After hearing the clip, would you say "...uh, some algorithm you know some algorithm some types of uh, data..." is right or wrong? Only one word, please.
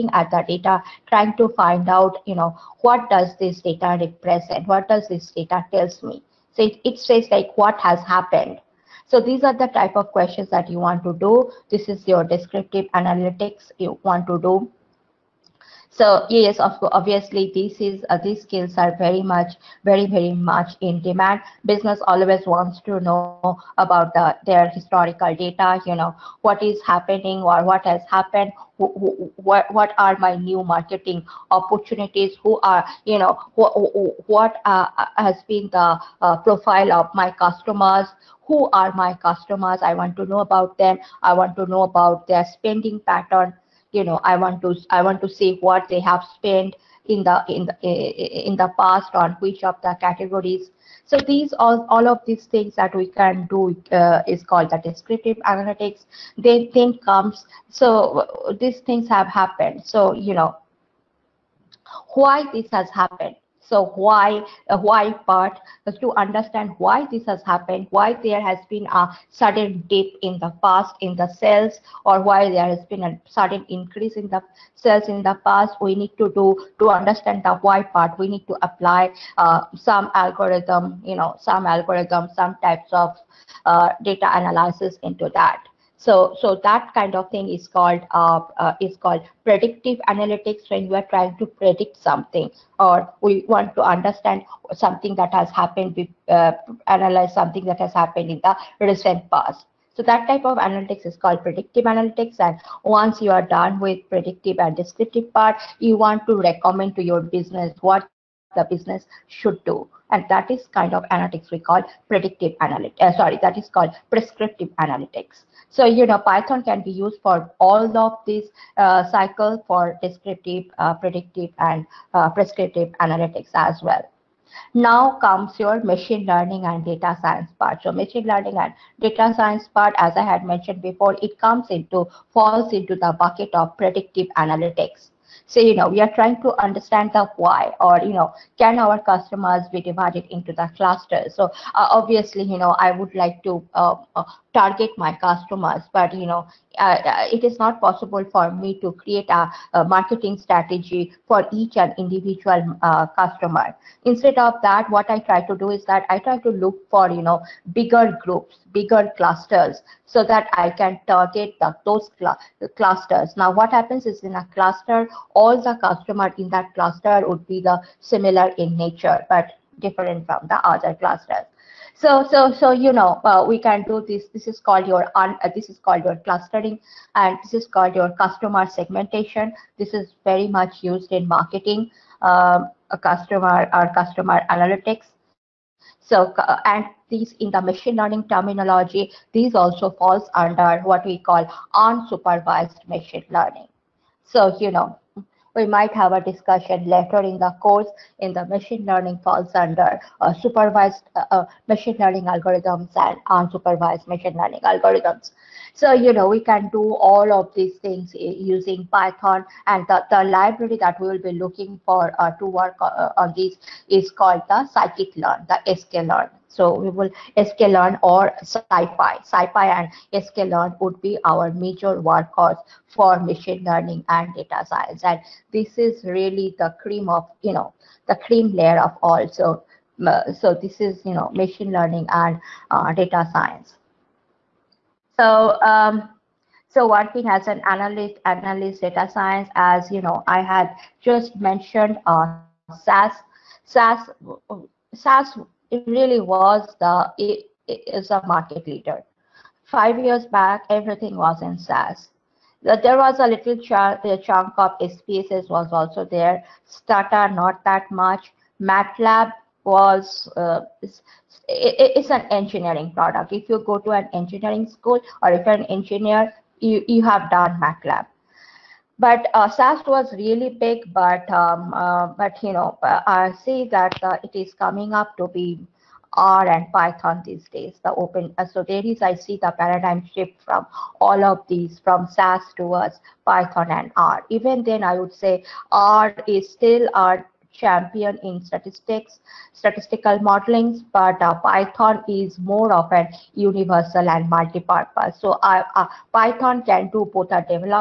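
right.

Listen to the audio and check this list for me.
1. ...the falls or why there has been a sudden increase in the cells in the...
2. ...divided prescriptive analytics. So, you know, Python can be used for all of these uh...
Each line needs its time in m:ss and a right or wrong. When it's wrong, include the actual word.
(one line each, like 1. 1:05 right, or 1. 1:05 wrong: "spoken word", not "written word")
1. 1:11 wrong: "cells", not "falls"
2. 1:53 wrong: "called", not "divided".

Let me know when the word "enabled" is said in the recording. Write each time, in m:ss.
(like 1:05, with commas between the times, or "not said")
not said.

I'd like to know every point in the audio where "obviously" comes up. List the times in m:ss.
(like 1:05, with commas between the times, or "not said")
0:16, 2:21.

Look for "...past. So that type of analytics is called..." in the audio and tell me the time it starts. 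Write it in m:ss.
1:39.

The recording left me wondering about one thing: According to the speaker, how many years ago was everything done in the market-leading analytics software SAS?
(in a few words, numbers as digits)
5.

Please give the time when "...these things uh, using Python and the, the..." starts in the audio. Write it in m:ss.
3:27.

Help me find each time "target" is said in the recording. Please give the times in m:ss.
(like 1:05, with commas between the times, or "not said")
2:24, 2:41.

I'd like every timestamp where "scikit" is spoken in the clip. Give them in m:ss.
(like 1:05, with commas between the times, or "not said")
3:34.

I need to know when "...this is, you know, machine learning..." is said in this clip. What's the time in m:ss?
3:50.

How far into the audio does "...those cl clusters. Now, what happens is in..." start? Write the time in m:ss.
2:41.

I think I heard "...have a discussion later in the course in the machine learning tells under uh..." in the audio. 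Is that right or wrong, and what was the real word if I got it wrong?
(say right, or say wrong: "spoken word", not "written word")
wrong: "falls", not "tells".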